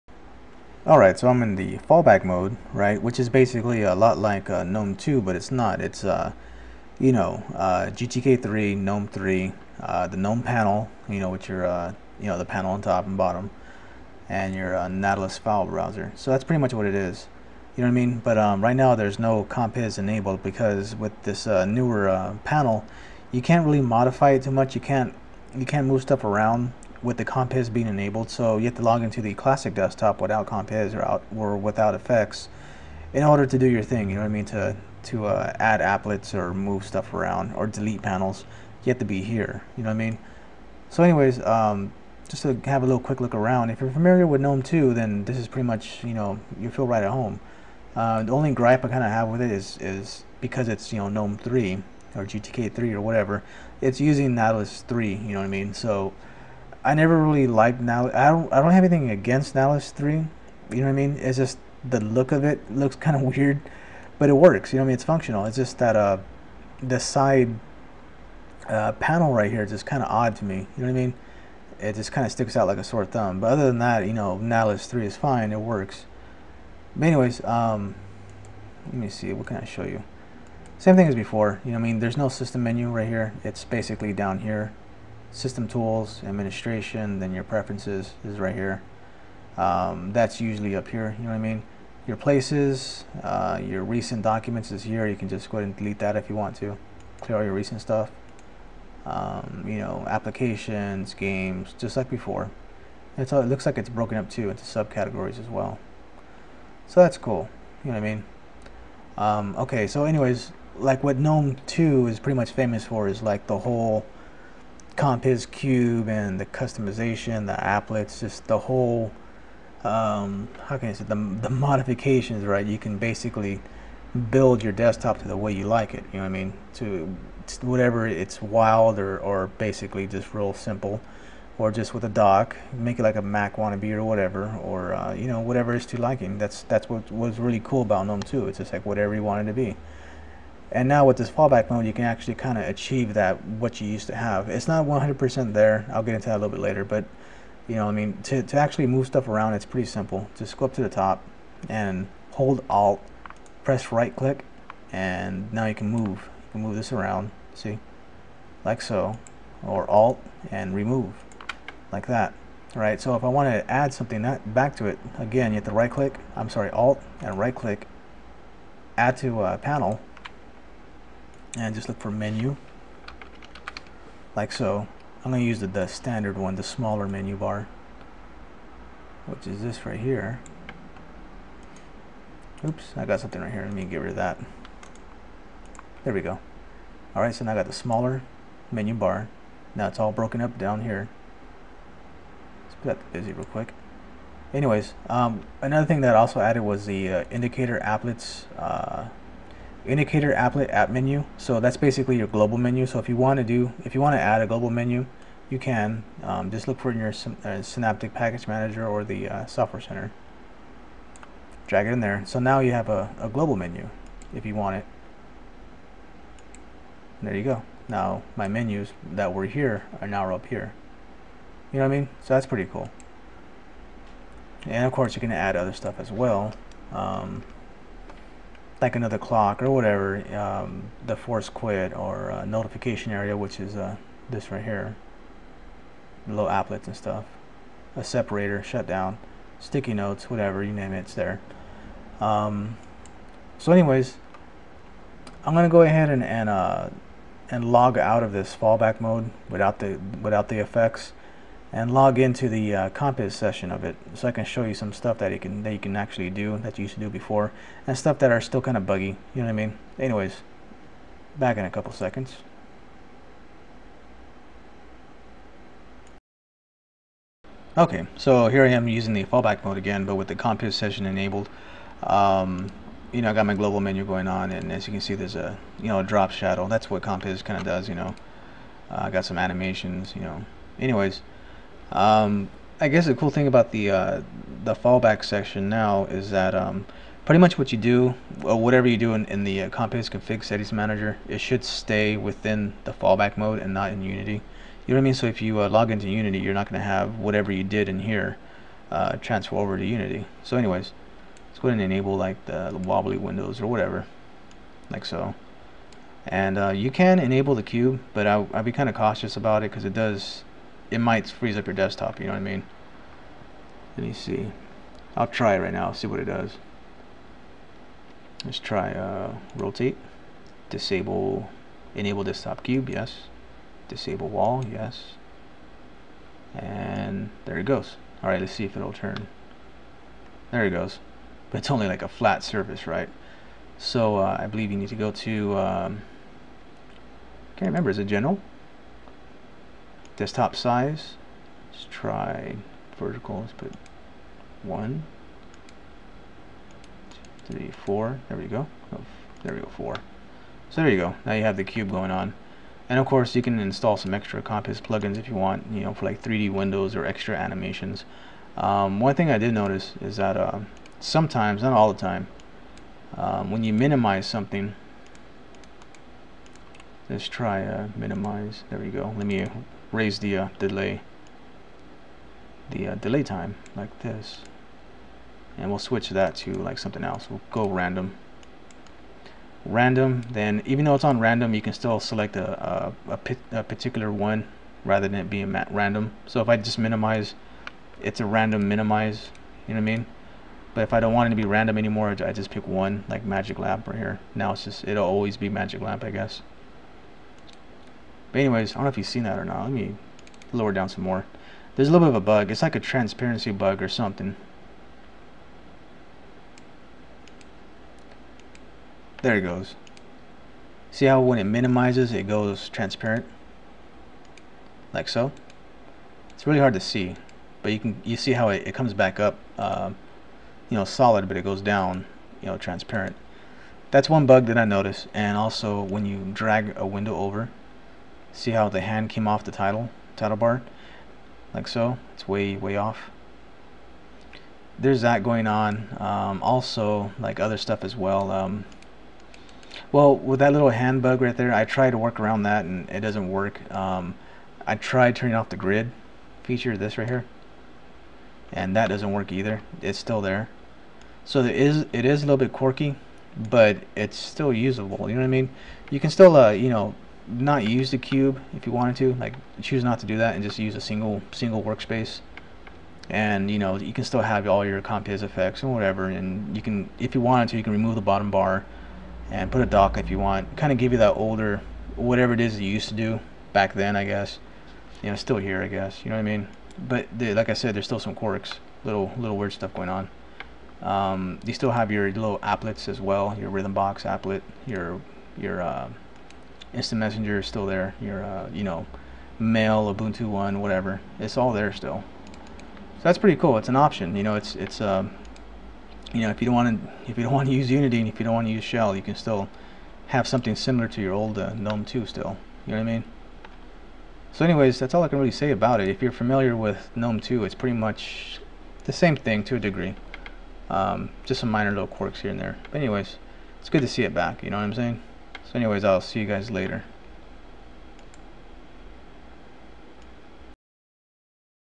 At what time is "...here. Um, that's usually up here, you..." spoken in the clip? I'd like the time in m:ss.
1:28.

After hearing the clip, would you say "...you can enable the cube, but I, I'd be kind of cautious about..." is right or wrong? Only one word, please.
right.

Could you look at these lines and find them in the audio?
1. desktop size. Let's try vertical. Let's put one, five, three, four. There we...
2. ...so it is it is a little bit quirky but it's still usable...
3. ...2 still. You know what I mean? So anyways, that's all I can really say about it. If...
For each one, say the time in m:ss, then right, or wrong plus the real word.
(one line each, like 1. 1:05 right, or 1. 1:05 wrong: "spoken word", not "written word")
1. 5:40 wrong: "two", not "five"
2. 7:31 right
3. 8:21 right.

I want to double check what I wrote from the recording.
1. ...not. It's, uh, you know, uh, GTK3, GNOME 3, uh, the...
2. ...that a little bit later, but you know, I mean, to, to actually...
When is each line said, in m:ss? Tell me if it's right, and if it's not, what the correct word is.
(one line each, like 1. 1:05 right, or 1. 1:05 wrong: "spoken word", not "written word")
1. 0:05 right
2. 2:26 right.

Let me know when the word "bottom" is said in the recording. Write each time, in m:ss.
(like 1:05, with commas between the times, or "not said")
0:13, 7:48.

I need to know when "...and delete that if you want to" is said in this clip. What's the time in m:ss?
1:35.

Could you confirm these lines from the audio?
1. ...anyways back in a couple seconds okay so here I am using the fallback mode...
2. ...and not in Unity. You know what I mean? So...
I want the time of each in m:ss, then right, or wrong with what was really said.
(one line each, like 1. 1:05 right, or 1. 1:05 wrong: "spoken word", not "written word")
1. 4:19 right
2. 4:53 right.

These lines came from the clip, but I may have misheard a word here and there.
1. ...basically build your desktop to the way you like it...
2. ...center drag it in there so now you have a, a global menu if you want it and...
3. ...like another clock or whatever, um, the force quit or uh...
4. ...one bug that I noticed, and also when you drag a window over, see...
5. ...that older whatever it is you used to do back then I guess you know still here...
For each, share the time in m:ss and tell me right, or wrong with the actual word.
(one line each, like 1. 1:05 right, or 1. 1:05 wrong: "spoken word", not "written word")
1. 2:02 right
2. 3:29 right
3. 3:48 right
4. 7:04 right
5. 7:50 right.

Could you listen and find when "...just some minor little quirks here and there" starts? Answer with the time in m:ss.
8:31.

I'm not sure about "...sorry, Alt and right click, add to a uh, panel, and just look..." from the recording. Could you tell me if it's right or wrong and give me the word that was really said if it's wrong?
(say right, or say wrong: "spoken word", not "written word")
right.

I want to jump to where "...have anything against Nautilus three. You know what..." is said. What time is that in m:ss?
0:58.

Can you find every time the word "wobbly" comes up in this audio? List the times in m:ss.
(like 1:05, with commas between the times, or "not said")
5:02.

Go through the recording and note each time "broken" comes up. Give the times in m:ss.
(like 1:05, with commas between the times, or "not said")
1:43, 3:10.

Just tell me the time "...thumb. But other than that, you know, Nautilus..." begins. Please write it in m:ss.
1:13.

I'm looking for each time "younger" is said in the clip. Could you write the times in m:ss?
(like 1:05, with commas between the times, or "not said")
not said.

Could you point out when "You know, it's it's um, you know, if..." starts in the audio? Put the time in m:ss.
8:14.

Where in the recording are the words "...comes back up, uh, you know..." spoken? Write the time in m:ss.
6:58.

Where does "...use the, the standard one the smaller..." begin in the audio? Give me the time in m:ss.
2:55.